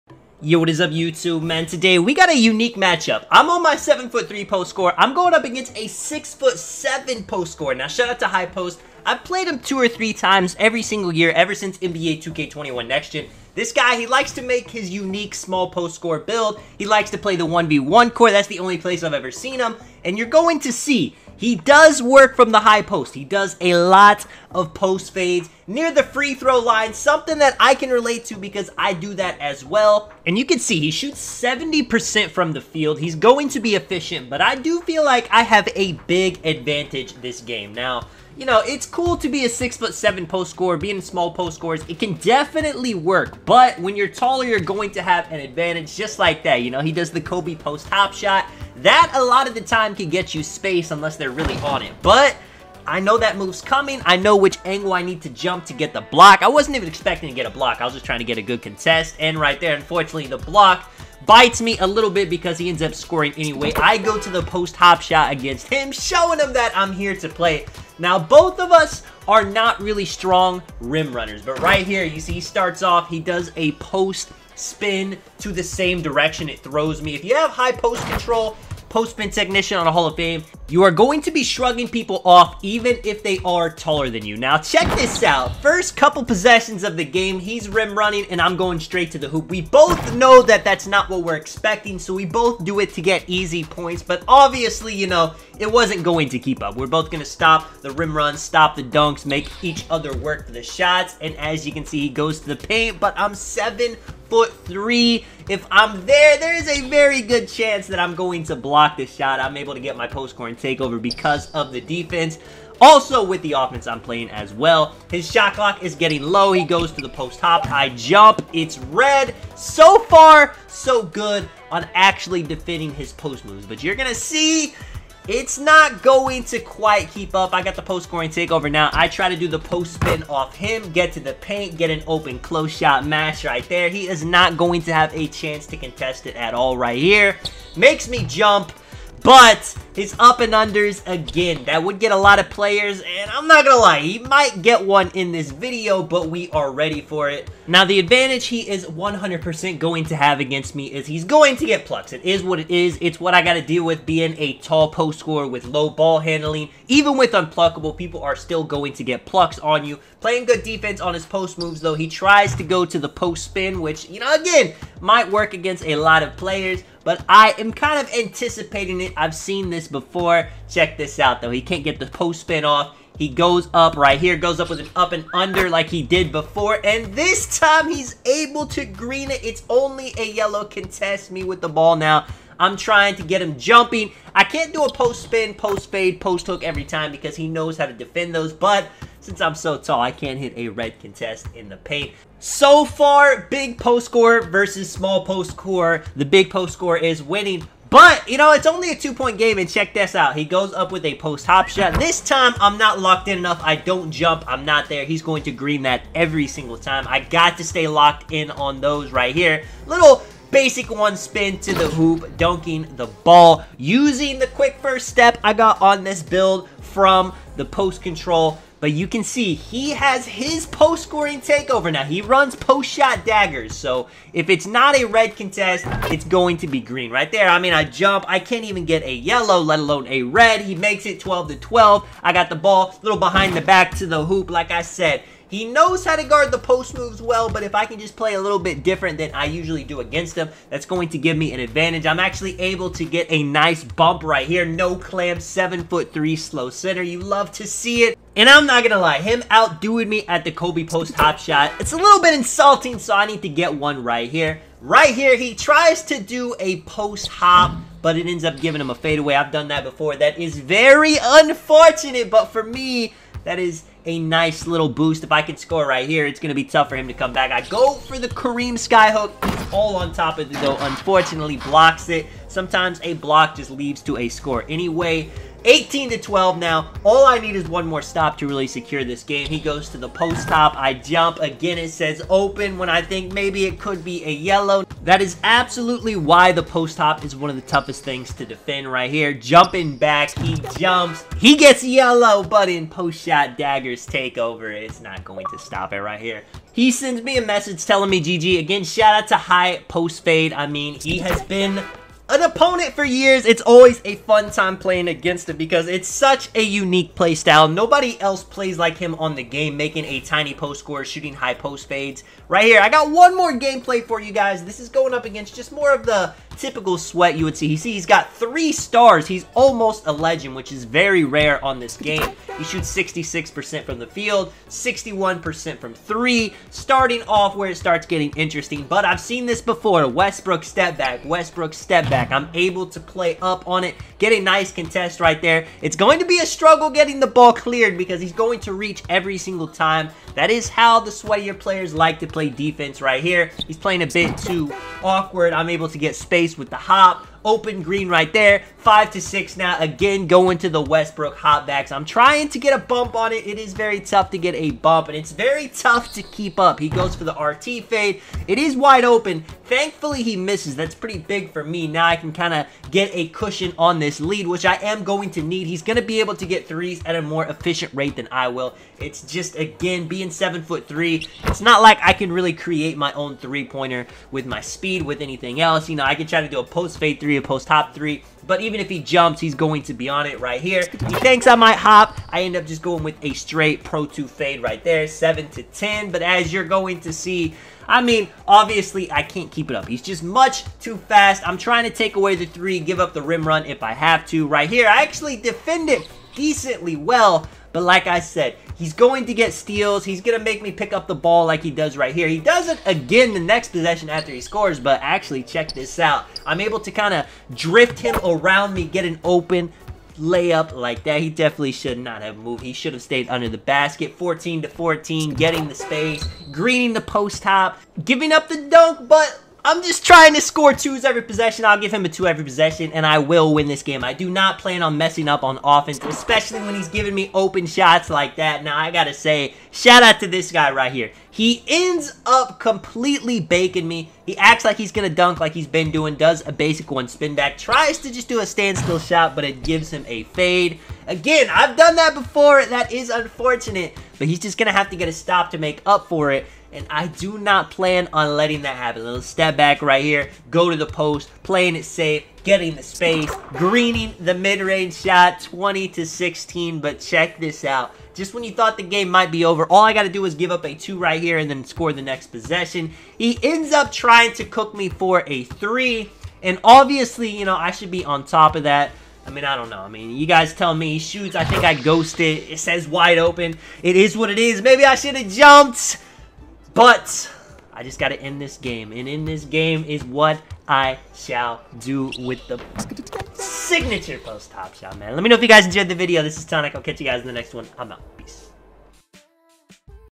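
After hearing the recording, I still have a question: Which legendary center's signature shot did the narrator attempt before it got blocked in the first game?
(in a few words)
Kareem Skyhook.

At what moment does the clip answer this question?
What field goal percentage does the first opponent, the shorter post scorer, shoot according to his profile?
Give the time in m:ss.
0:31.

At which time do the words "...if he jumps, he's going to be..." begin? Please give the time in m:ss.
6:18.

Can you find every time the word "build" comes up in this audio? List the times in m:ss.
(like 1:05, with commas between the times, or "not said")
0:16, 3:36.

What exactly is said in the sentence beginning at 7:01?
I'll give him a two every possession, and I will win this game.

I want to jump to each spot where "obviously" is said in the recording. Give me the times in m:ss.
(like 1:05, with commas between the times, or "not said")
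1:34, 6:28, 7:46.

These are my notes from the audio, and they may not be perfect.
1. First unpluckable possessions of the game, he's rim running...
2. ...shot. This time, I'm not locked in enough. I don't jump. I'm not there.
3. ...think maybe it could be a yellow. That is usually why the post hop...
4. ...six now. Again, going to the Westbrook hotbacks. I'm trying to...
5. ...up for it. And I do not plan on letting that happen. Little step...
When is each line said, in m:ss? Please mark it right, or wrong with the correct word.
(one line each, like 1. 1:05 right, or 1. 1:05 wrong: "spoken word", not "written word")
1. 1:25 wrong: "couple", not "unpluckable"
2. 3:21 right
3. 4:43 wrong: "absolutely", not "usually"
4. 5:49 right
5. 7:25 right.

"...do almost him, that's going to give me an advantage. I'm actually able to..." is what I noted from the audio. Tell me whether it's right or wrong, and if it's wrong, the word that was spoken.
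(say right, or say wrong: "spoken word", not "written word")
wrong: "against", not "almost".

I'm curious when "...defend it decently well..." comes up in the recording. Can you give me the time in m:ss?
6:35.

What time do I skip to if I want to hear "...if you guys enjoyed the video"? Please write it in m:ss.
8:05.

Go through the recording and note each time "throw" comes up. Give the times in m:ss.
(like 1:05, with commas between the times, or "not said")
0:26, 1:16.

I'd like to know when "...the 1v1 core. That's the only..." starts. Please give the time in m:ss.
0:17.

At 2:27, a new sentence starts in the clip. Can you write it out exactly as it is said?
Now, the advantage he is 100% going to have against me is he's going to get plucks.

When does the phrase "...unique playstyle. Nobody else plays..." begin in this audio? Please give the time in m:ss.
5:06.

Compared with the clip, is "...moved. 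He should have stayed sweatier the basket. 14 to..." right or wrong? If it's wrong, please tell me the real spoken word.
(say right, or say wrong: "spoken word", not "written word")
wrong: "under", not "sweatier".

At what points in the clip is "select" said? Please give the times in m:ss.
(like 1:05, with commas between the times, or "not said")
not said.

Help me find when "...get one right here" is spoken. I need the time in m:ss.
4:13.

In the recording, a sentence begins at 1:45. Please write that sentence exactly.
If I'm there, there is a very good chance that I'm going to block this shot.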